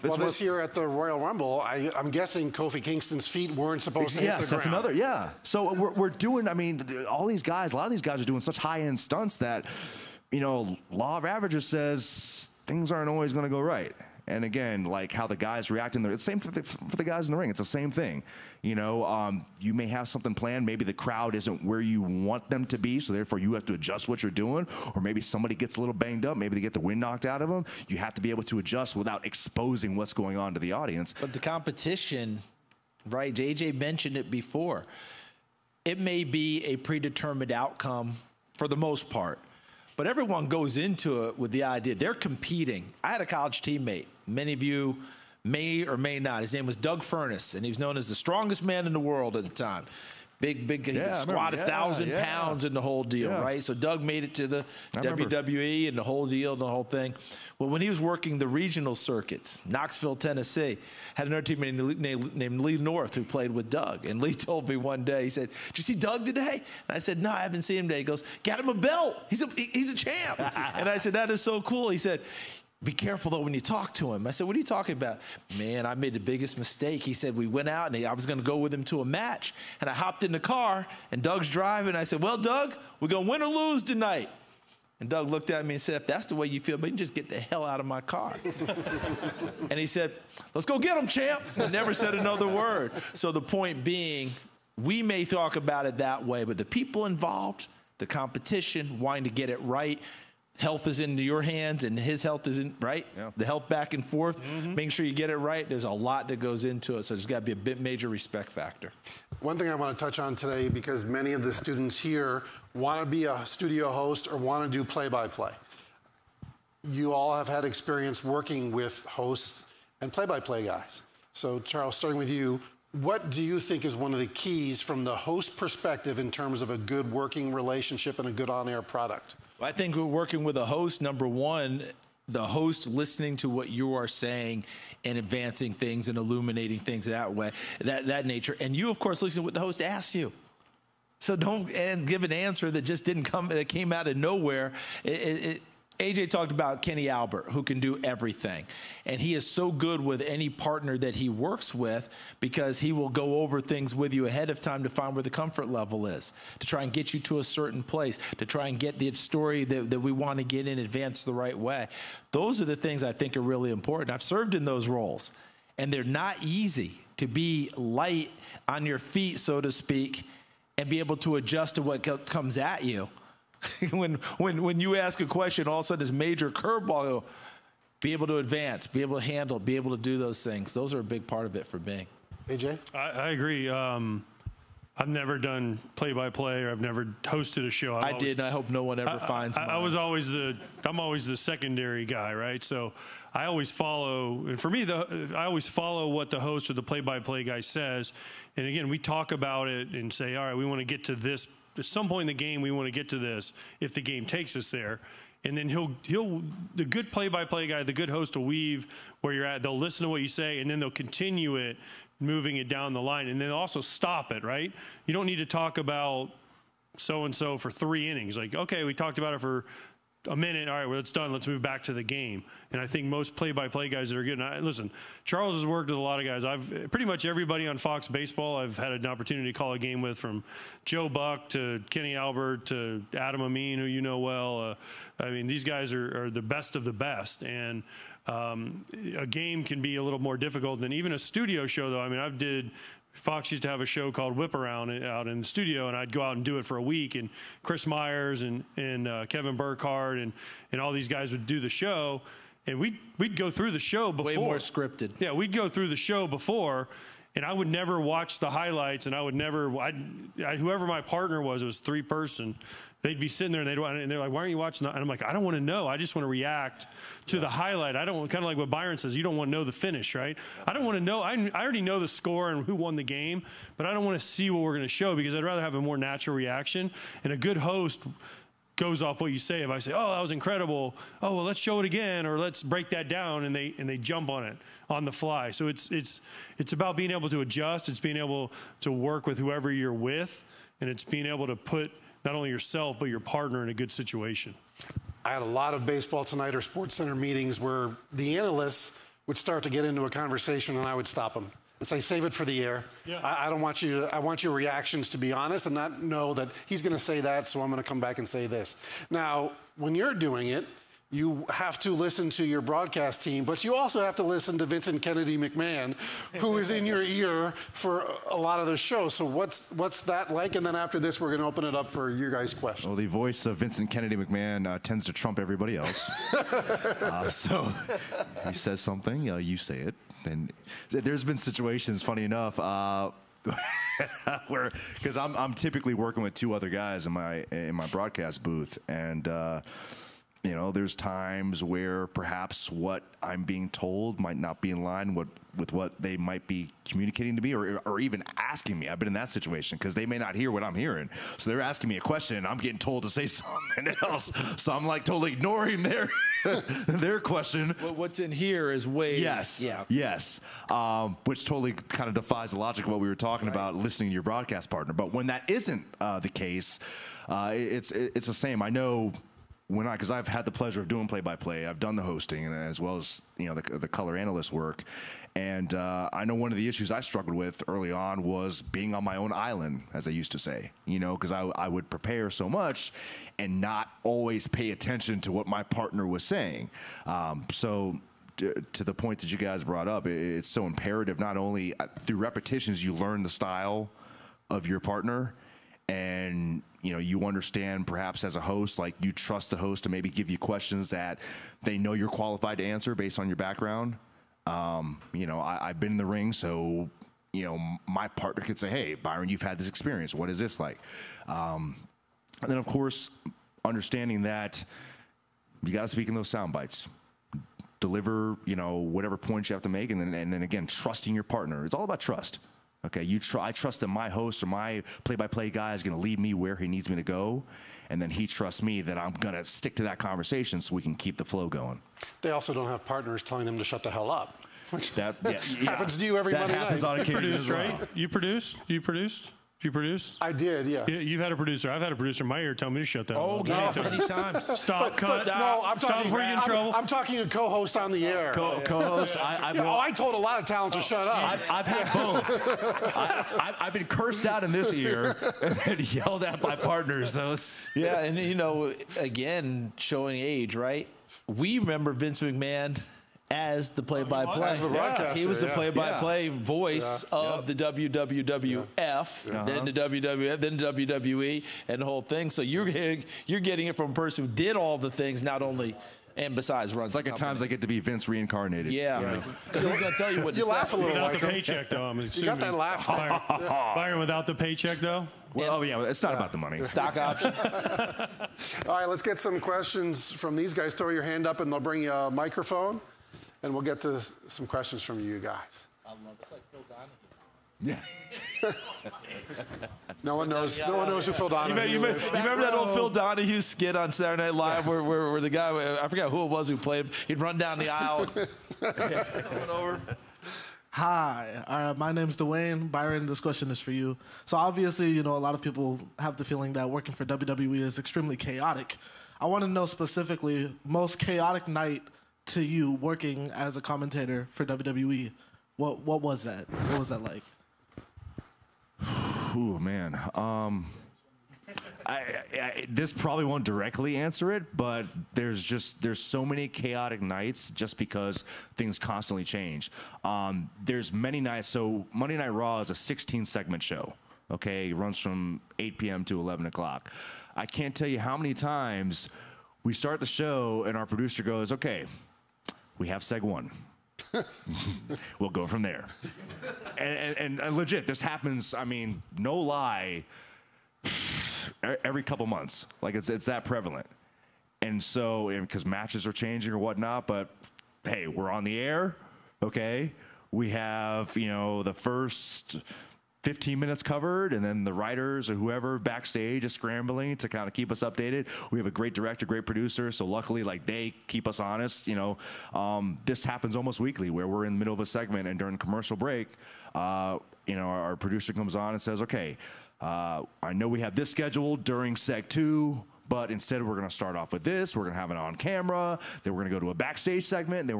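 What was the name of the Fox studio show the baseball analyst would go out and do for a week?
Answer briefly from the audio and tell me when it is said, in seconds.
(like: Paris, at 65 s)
Whip Around, at 244 s.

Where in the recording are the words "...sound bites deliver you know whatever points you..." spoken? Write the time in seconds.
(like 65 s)
416 s.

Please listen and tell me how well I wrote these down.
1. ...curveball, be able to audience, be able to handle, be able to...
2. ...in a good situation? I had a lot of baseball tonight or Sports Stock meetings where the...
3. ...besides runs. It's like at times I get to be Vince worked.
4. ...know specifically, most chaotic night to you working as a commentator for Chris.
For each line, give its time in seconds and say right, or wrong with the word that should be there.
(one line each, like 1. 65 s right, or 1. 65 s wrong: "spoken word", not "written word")
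1. 176 s wrong: "advance", not "audience"
2. 293 s wrong: "Center", not "Stock"
3. 476 s wrong: "reincarnated", not "worked"
4. 519 s wrong: "WWE", not "Chris".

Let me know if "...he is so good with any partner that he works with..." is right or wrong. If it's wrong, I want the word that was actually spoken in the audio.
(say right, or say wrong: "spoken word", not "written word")
right.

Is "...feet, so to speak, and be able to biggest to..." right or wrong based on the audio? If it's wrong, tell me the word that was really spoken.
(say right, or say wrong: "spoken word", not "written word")
wrong: "adjust", not "biggest".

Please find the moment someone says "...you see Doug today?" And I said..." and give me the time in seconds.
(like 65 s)
65 s.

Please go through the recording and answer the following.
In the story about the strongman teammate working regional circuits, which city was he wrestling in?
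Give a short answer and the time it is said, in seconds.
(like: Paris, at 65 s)
Knoxville, at 59 s.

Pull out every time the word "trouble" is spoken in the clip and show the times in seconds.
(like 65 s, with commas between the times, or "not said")
446 s.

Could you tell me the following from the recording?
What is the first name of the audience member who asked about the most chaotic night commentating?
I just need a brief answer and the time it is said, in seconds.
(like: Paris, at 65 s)
Dwayne, at 512 s.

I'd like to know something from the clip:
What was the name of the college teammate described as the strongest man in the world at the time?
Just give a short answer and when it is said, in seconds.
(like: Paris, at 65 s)
Doug Furnas, at 46 s.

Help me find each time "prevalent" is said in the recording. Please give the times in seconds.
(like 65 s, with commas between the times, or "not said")
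563 s.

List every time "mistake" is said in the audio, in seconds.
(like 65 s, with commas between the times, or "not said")
76 s.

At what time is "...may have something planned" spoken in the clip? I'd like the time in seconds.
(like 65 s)
19 s.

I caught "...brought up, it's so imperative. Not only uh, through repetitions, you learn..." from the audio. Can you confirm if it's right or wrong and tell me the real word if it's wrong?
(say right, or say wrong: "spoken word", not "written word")
right.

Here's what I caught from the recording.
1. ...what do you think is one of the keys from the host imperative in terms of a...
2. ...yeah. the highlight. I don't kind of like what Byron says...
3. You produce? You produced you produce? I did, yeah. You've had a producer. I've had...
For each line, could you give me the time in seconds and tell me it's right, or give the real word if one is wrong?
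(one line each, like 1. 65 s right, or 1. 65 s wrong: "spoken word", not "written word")
1. 122 s wrong: "perspective", not "imperative"
2. 267 s right
3. 437 s right.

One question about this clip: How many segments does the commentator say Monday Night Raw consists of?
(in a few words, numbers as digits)
16.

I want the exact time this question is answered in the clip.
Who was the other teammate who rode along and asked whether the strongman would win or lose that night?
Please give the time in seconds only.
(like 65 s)
62 s.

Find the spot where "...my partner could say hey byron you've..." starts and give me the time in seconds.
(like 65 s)
407 s.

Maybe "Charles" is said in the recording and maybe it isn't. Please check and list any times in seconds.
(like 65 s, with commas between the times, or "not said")
121 s, 225 s.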